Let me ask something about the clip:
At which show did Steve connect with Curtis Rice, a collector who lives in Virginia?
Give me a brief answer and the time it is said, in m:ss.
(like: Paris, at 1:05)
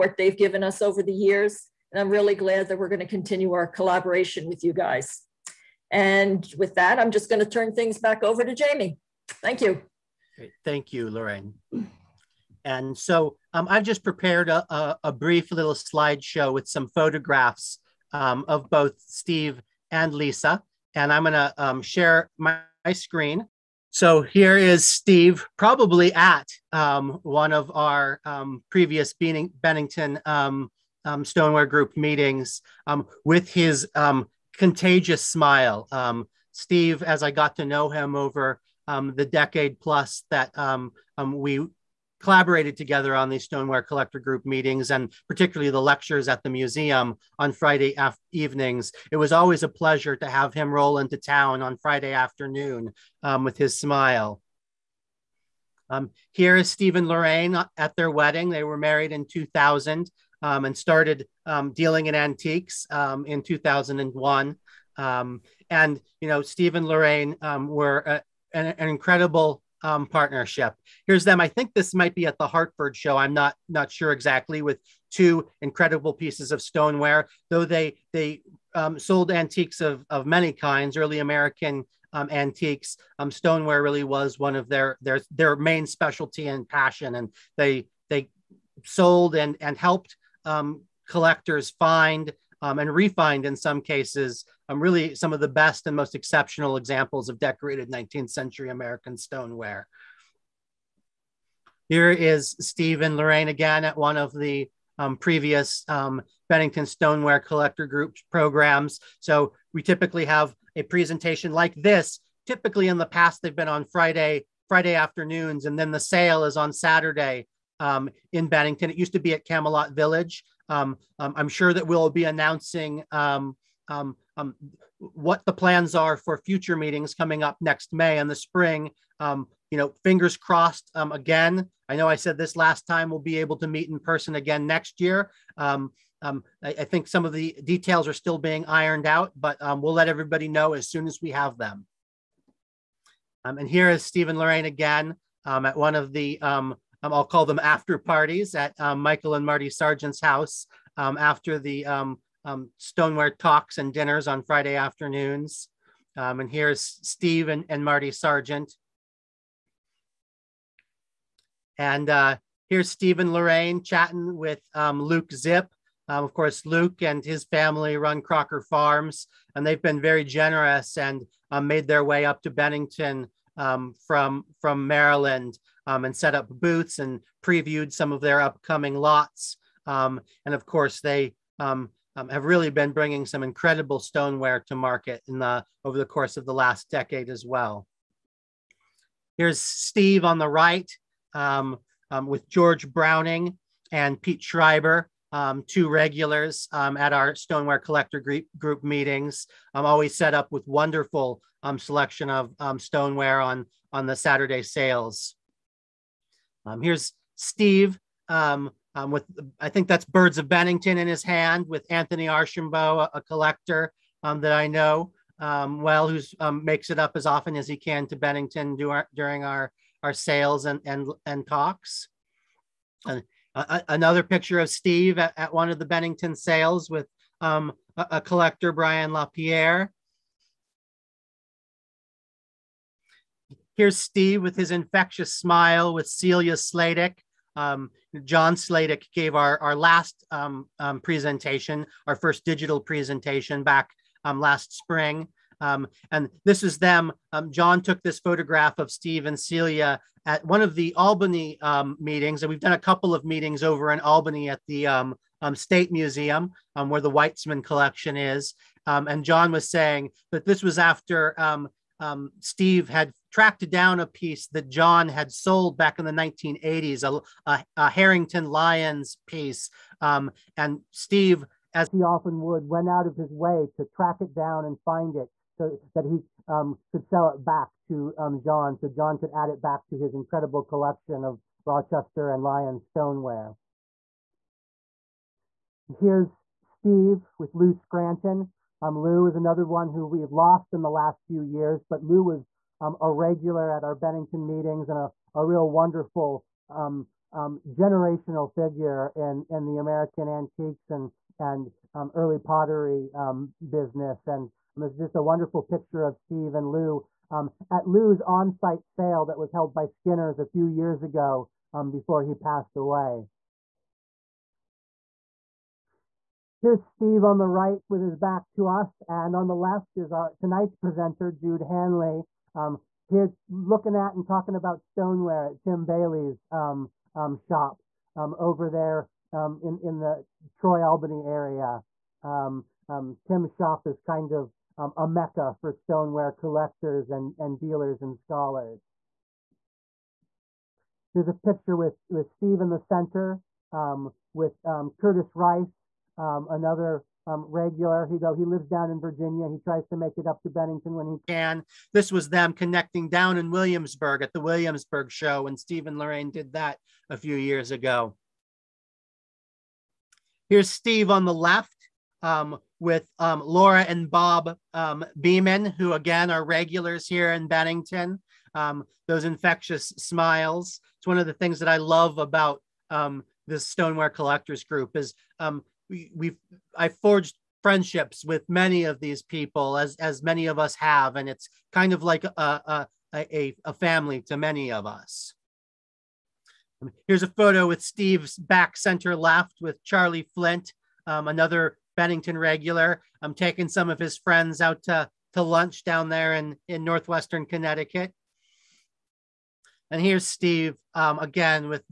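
Williamsburg show, at 5:54.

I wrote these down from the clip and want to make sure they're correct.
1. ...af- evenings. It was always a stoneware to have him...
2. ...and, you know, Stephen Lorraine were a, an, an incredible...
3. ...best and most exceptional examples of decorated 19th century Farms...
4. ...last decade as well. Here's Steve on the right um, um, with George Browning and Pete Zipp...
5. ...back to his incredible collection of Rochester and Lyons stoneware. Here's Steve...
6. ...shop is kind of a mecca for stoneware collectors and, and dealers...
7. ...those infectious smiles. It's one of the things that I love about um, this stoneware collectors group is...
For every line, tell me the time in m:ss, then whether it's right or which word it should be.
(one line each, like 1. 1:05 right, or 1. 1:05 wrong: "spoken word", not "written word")
1. 0:47 wrong: "pleasure", not "stoneware"
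2. 1:05 right
3. 1:35 wrong: "American", not "Farms"
4. 3:06 wrong: "Schreiber", not "Zipp"
5. 4:39 right
6. 5:33 right
7. 6:09 right.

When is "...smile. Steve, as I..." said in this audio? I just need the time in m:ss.
0:35.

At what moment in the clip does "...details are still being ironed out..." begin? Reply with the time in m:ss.
2:17.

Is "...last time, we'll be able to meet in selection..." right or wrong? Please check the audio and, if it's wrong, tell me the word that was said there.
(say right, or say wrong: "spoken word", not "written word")
wrong: "person", not "selection".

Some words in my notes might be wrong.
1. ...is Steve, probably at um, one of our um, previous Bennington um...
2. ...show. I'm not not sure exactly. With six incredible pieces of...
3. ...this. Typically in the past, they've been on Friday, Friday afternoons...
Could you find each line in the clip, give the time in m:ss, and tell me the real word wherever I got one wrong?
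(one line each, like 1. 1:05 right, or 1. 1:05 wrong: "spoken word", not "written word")
1. 0:24 right
2. 1:12 wrong: "two", not "six"
3. 1:51 right.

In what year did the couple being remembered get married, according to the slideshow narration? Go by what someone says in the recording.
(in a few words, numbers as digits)
2000.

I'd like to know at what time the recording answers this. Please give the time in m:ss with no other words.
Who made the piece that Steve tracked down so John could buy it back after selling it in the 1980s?
4:27.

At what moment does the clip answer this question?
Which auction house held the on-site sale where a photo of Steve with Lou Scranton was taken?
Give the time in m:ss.
5:09.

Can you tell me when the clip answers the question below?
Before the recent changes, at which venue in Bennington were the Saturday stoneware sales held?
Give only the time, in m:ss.
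1:59.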